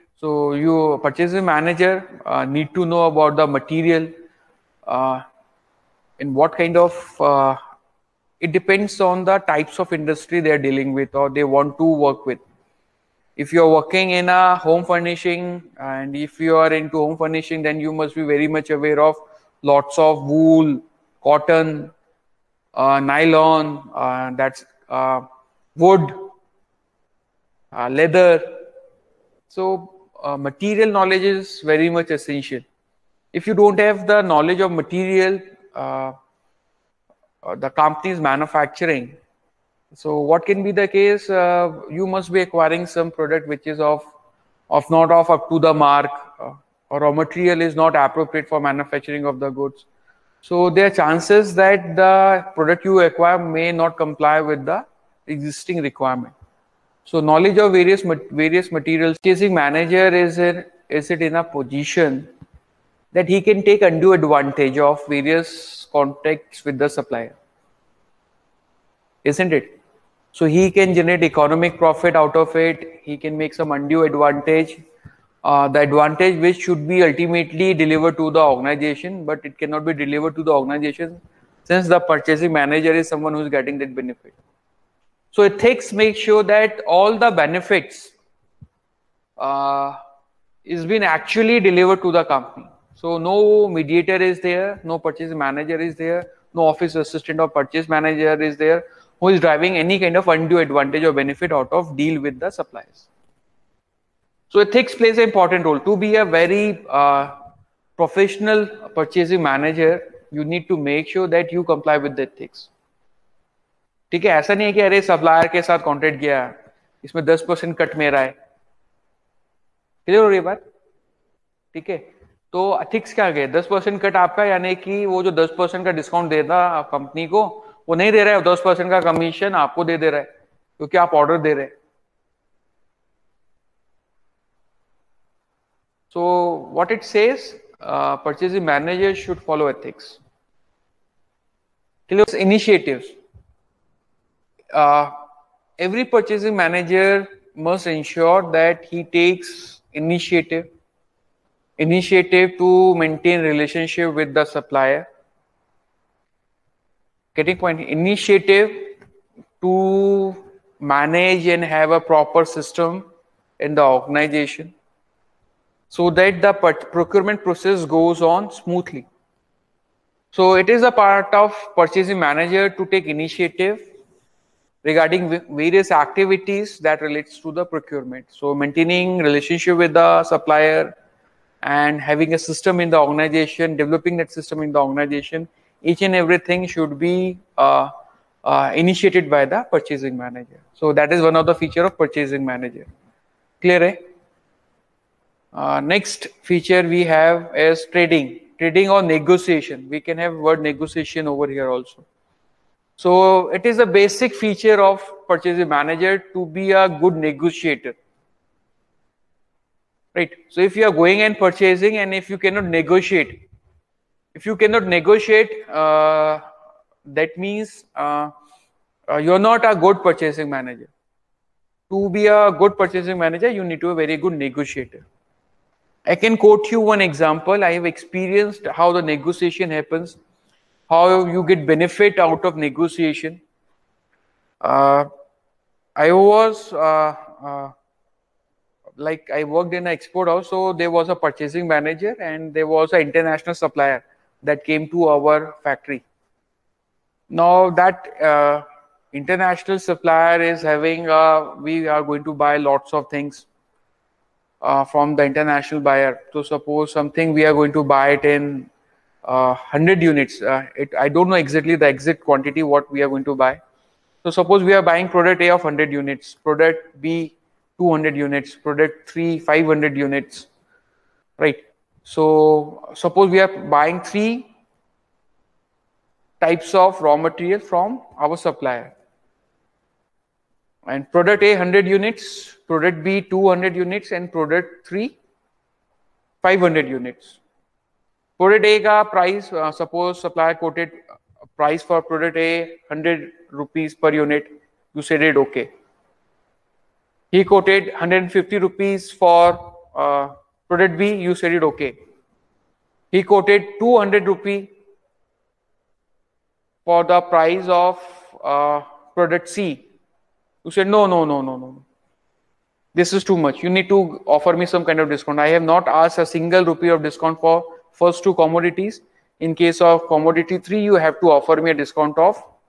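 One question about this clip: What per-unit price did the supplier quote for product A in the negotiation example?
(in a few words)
100 rupees.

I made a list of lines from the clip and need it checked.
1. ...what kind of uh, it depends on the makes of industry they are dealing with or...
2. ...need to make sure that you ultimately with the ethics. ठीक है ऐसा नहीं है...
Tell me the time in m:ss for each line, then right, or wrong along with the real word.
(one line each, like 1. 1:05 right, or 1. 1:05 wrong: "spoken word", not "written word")
1. 0:06 wrong: "types", not "makes"
2. 1:50 wrong: "comply", not "ultimately".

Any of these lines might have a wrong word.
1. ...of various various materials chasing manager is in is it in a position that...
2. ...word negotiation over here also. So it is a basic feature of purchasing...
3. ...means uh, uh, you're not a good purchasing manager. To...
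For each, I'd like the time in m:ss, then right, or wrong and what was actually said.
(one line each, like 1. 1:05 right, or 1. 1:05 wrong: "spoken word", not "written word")
1. 0:57 right
2. 3:20 right
3. 3:37 right.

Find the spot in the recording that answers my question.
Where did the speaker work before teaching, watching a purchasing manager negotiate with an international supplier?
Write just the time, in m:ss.
3:59.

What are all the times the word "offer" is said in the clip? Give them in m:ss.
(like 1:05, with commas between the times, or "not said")
5:14, 5:21.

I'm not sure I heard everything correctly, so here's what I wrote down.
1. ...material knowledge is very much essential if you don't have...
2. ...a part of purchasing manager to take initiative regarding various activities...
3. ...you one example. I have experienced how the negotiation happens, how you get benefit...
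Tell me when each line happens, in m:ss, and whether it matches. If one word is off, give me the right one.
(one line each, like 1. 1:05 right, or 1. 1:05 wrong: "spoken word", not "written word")
1. 0:30 right
2. 2:50 right
3. 3:46 right.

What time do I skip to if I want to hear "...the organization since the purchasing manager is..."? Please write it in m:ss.
1:20.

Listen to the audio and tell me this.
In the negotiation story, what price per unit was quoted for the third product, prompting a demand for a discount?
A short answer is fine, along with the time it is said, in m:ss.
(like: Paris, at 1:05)
200 rupees, at 5:03.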